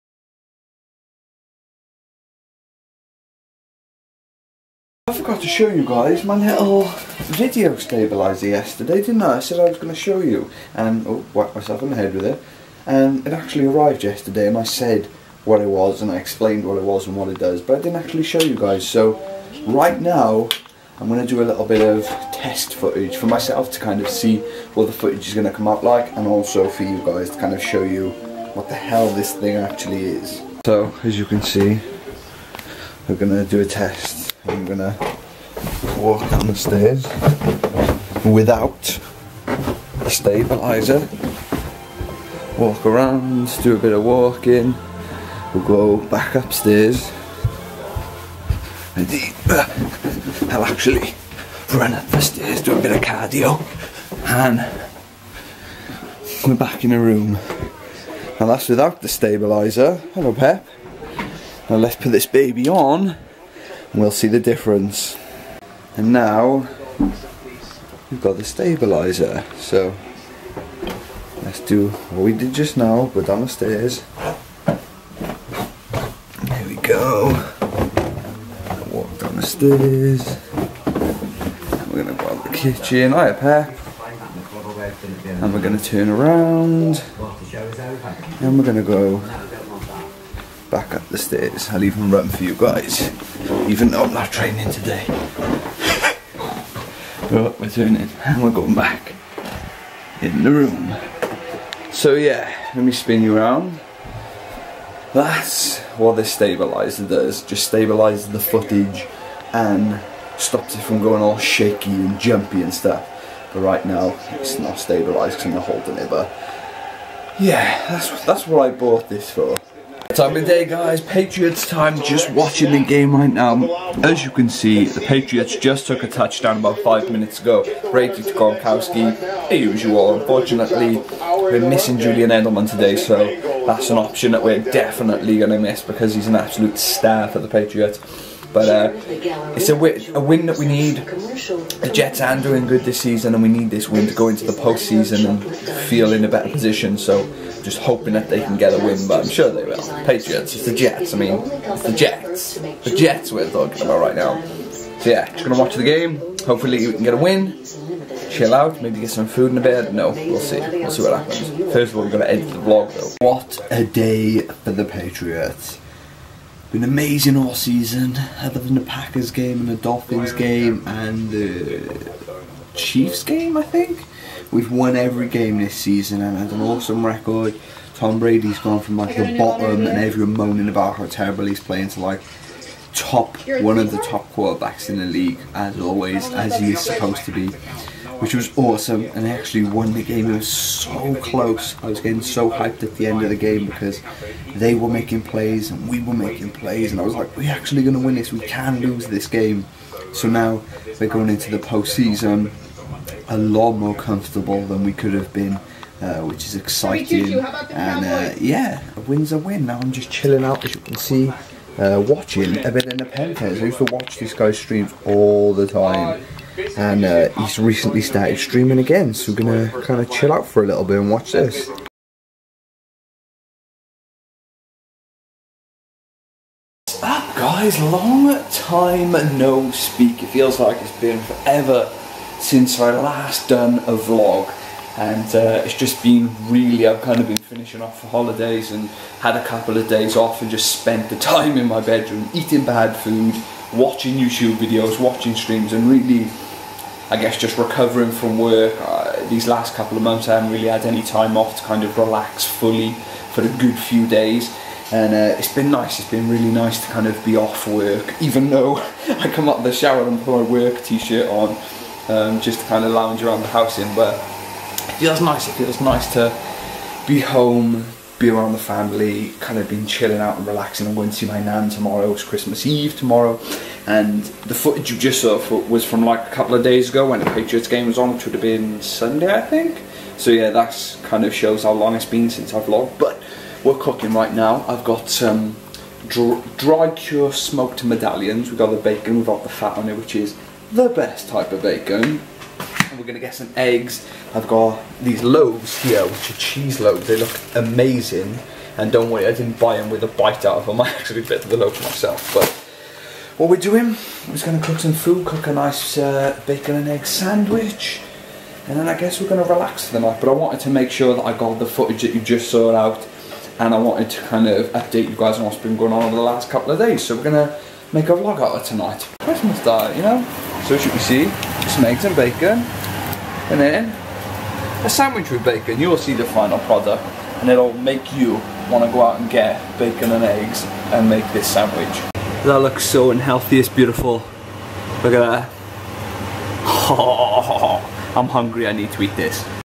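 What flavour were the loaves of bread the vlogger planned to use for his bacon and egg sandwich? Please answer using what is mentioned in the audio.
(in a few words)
Cheese.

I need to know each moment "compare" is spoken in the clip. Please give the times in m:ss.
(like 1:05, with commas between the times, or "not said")
not said.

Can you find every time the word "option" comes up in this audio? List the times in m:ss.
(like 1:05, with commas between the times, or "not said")
2:13.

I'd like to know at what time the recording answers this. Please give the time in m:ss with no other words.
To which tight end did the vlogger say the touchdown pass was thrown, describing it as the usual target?
2:08.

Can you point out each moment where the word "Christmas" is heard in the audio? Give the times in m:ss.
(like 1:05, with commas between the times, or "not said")
4:32, 5:19.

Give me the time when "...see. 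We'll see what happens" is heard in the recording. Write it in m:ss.
2:40.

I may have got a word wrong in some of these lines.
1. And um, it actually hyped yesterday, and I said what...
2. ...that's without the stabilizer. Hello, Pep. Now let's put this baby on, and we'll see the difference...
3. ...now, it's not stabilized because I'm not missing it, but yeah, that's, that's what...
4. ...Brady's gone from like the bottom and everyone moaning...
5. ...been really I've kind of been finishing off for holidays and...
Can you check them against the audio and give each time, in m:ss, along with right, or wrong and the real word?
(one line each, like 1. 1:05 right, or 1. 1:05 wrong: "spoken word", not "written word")
1. 0:12 wrong: "arrived", not "hyped"
2. 0:58 right
3. 1:53 wrong: "holding", not "missing"
4. 2:58 right
5. 3:56 right.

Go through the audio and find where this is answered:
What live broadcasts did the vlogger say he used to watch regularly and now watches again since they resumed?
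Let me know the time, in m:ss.
3:33.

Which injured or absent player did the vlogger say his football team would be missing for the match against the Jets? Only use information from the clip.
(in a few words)
Julian Edelman.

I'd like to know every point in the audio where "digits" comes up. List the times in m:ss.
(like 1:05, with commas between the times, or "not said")
not said.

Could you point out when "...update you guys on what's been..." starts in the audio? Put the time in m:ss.
5:14.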